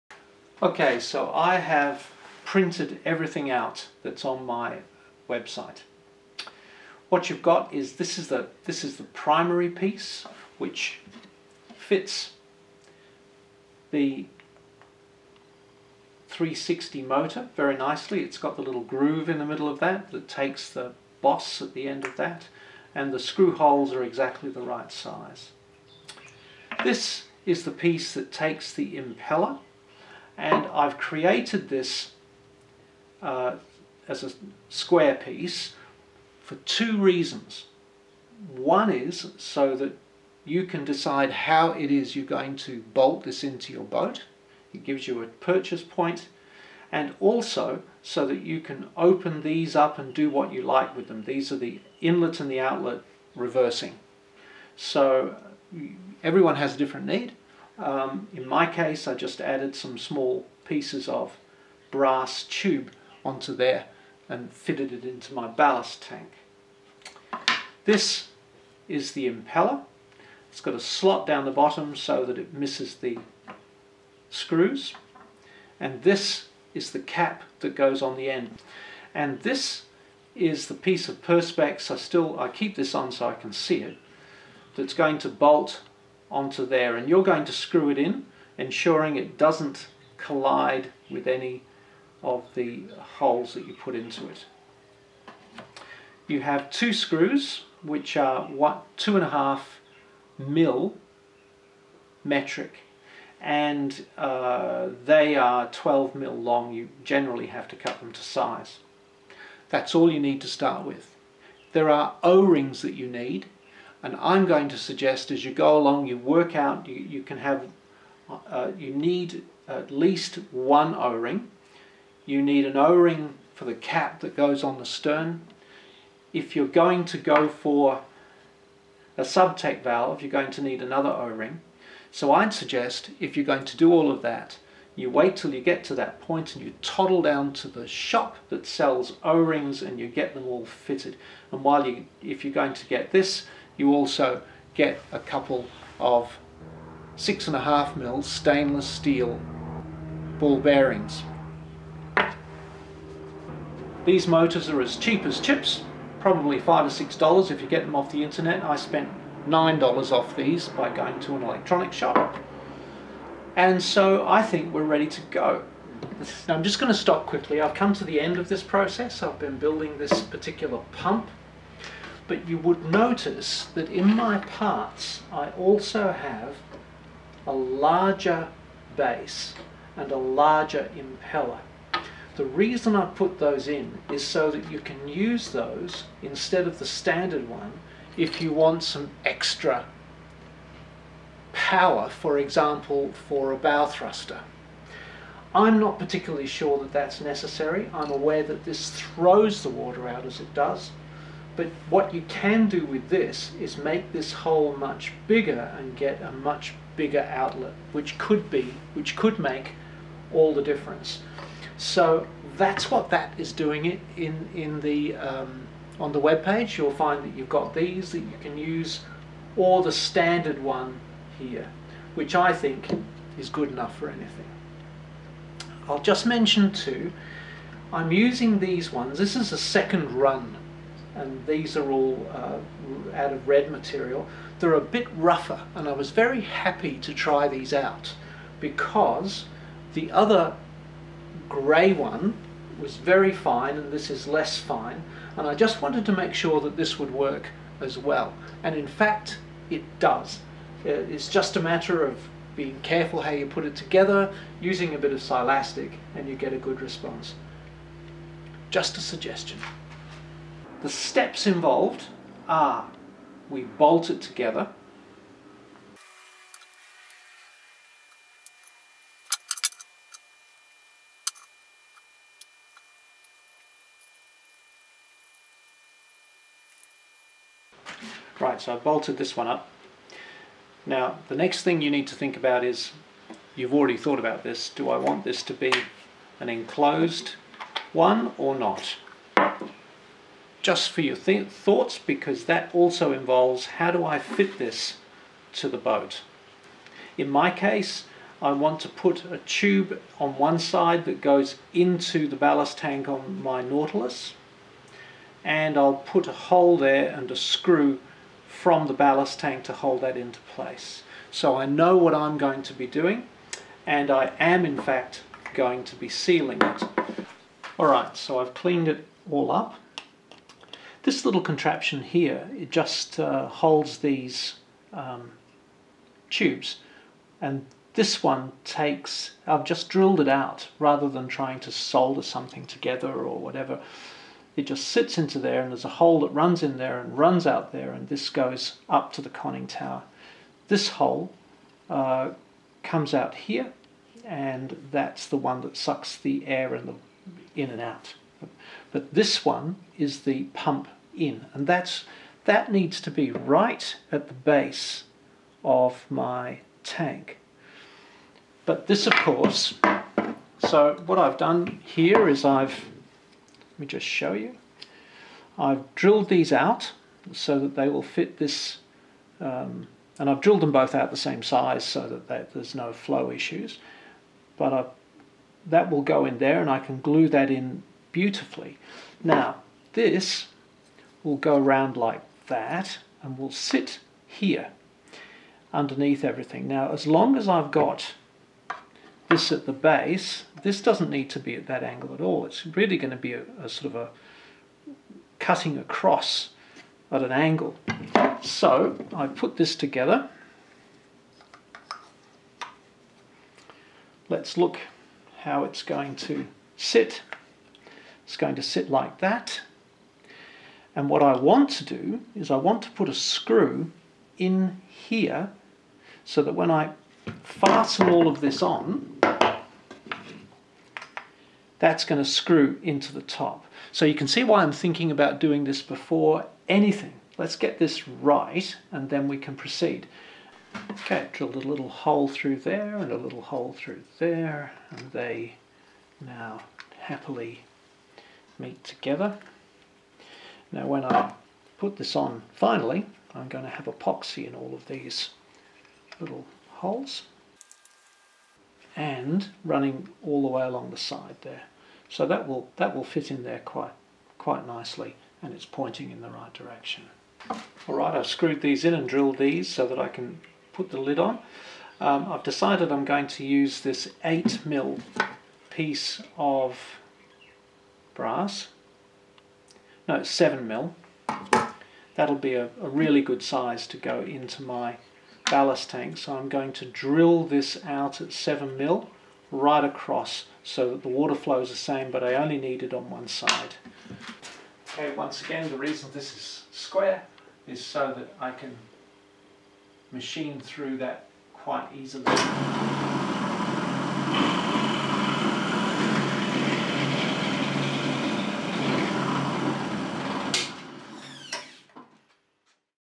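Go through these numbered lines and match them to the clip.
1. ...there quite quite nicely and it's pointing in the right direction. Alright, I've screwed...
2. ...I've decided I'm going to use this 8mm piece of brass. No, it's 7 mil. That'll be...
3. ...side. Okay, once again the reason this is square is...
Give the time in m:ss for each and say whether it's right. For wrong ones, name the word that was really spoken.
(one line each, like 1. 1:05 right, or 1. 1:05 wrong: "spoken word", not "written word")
1. 7:33 right
2. 7:42 right
3. 8:03 right.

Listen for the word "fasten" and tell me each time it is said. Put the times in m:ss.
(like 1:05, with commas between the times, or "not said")
6:57.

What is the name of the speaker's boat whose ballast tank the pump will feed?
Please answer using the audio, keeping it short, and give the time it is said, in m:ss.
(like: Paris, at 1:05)
Nautilus, at 5:03.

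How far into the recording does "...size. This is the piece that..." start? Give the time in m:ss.
0:24.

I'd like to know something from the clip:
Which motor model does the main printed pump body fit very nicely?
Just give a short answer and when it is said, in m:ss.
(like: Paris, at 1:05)
360, at 0:16.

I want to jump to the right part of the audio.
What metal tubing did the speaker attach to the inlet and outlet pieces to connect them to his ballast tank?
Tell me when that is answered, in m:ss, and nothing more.
1:01.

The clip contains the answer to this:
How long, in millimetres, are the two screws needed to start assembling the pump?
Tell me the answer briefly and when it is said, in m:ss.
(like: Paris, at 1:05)
12, at 1:45.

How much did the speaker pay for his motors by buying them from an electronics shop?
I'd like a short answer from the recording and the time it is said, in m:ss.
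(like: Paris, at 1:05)
9 dollars, at 2:39.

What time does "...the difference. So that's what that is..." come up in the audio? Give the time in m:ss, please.
3:30.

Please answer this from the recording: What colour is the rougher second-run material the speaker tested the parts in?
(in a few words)
red.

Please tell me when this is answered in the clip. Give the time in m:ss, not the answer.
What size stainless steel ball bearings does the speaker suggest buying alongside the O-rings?
2:27.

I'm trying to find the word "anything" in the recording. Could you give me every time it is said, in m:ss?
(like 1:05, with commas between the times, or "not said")
3:44, 7:06.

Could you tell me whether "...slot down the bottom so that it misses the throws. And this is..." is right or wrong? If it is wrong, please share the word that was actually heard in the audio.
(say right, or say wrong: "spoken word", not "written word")
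wrong: "screws", not "throws".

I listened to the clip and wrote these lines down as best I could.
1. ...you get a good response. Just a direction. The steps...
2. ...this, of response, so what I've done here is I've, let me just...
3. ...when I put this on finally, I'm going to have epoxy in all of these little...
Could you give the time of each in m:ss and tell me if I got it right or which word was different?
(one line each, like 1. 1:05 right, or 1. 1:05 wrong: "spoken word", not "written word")
1. 4:16 wrong: "suggestion", not "direction"
2. 5:58 wrong: "course", not "response"
3. 7:20 right.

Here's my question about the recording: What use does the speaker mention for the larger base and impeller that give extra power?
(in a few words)
bow thruster.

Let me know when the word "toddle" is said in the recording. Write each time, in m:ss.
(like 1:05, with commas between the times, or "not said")
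2:16.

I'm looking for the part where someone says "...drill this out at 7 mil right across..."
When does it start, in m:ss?
7:56.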